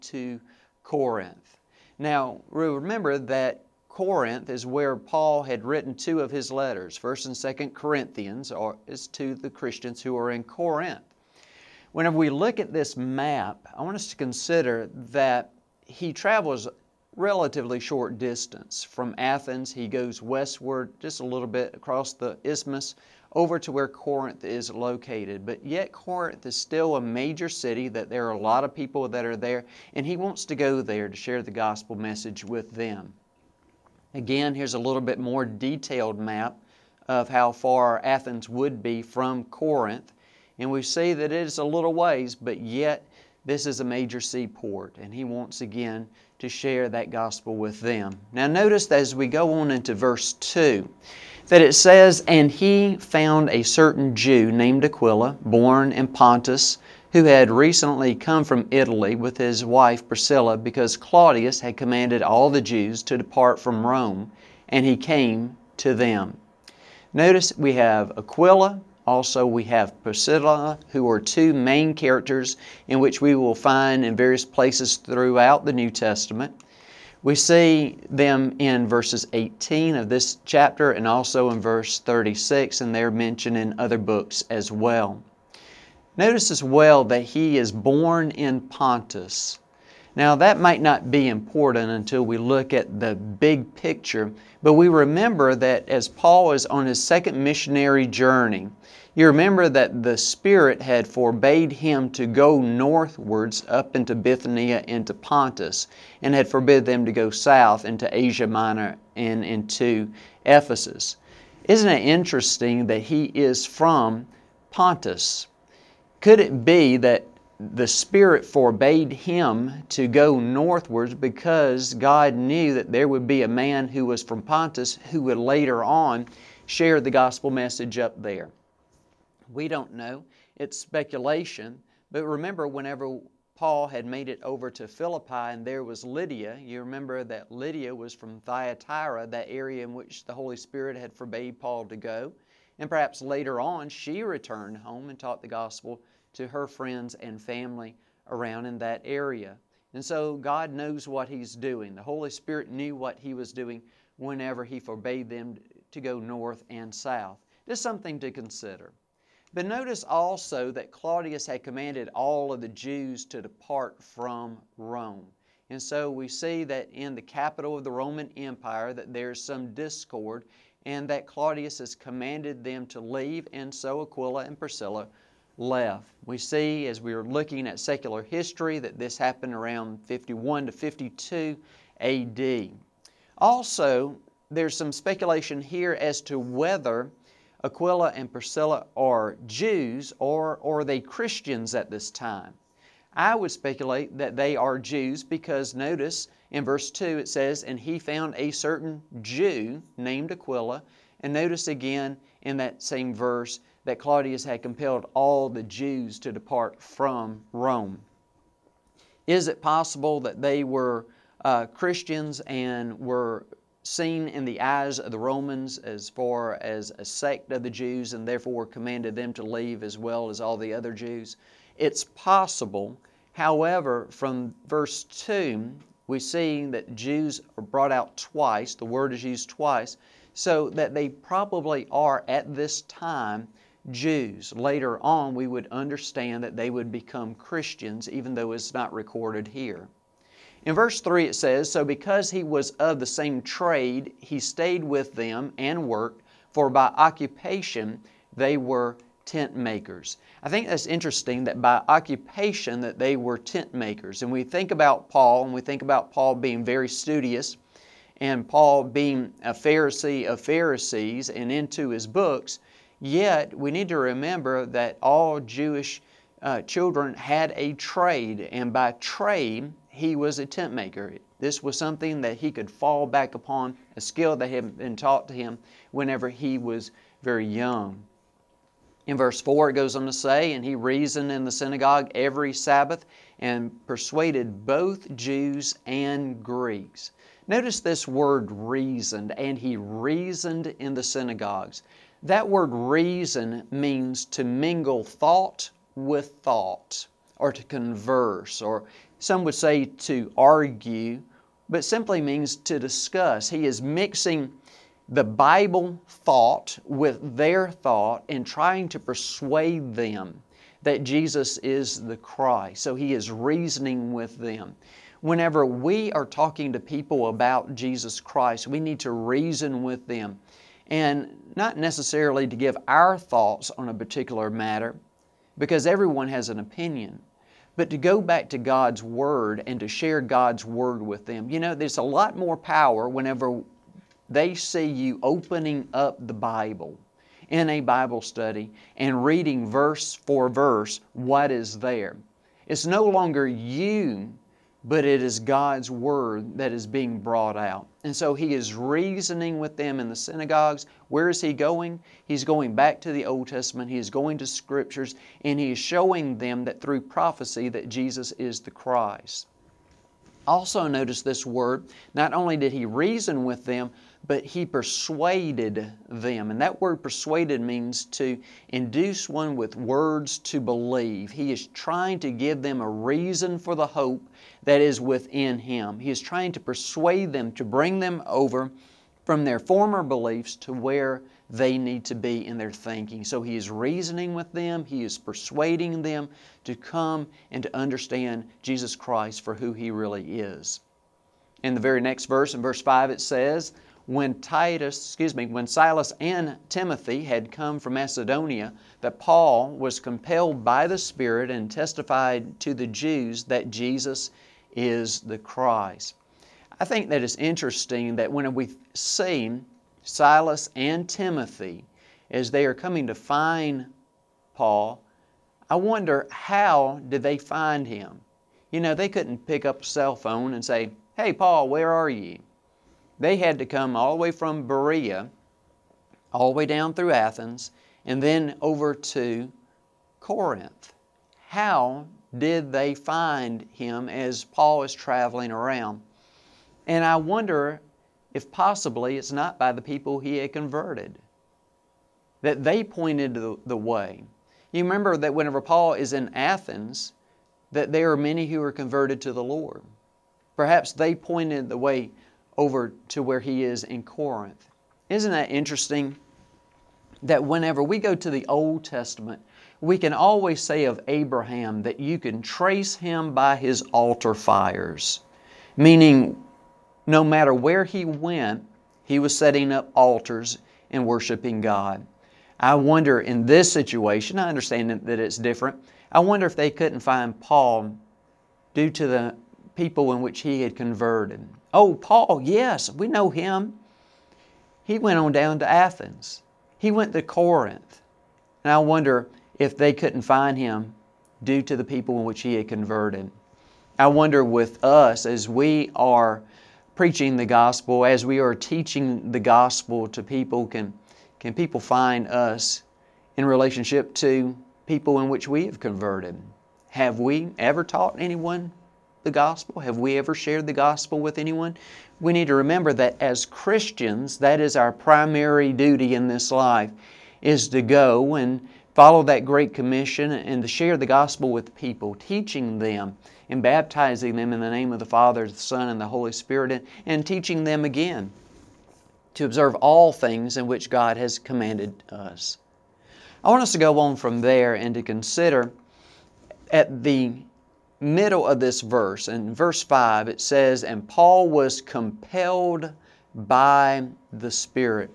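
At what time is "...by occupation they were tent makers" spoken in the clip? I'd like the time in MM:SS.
04:06.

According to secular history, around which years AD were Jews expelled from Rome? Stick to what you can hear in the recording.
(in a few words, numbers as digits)
51 to 52 AD.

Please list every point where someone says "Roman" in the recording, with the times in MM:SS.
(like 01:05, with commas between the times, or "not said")
02:47, 03:35.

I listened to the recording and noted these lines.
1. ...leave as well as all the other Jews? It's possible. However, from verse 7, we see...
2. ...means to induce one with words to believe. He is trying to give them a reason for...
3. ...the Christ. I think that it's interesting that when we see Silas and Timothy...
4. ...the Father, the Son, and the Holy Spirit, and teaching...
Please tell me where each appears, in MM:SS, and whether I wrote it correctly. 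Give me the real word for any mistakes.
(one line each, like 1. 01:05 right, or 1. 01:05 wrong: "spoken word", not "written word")
1. 03:39 wrong: "2", not "7"
2. 06:07 right
3. 06:45 right
4. 08:44 right.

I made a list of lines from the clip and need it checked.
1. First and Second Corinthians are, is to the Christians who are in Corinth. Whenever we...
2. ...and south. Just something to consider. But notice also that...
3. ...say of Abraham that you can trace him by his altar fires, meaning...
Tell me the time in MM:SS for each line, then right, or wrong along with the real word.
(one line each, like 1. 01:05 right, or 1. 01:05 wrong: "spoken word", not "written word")
1. 00:06 right
2. 02:36 right
3. 07:40 right.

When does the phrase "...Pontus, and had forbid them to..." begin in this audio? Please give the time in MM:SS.
01:45.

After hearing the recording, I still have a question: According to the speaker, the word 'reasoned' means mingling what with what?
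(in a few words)
Thought with thought.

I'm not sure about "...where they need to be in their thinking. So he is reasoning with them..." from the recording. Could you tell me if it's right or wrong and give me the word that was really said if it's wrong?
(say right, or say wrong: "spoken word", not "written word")
right.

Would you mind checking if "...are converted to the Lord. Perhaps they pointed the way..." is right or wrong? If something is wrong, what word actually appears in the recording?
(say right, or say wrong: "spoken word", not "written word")
right.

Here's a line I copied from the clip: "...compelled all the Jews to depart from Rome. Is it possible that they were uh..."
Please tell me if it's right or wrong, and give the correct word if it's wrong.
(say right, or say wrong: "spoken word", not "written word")
right.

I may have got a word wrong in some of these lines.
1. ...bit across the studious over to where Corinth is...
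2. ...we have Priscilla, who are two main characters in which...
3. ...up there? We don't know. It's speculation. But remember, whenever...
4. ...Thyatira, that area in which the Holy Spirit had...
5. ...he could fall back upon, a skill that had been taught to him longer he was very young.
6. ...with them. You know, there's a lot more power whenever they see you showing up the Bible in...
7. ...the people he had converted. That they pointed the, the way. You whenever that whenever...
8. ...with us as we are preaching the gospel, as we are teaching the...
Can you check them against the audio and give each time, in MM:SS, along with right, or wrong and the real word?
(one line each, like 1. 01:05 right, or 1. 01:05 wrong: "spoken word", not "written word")
1. 00:21 wrong: "isthmus", not "studious"
2. 01:09 right
3. 02:07 right
4. 02:18 right
5. 04:32 wrong: "whenever", not "longer"
6. 05:31 wrong: "opening", not "showing"
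7. 07:19 wrong: "remember", not "whenever"
8. 08:14 right.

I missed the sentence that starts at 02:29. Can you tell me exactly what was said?
And so God knows what He's doing.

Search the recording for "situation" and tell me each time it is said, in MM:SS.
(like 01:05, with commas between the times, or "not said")
07:53.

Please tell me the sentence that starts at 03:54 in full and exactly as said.
Later on, we would understand that they would become Christians, even though it's not recorded here.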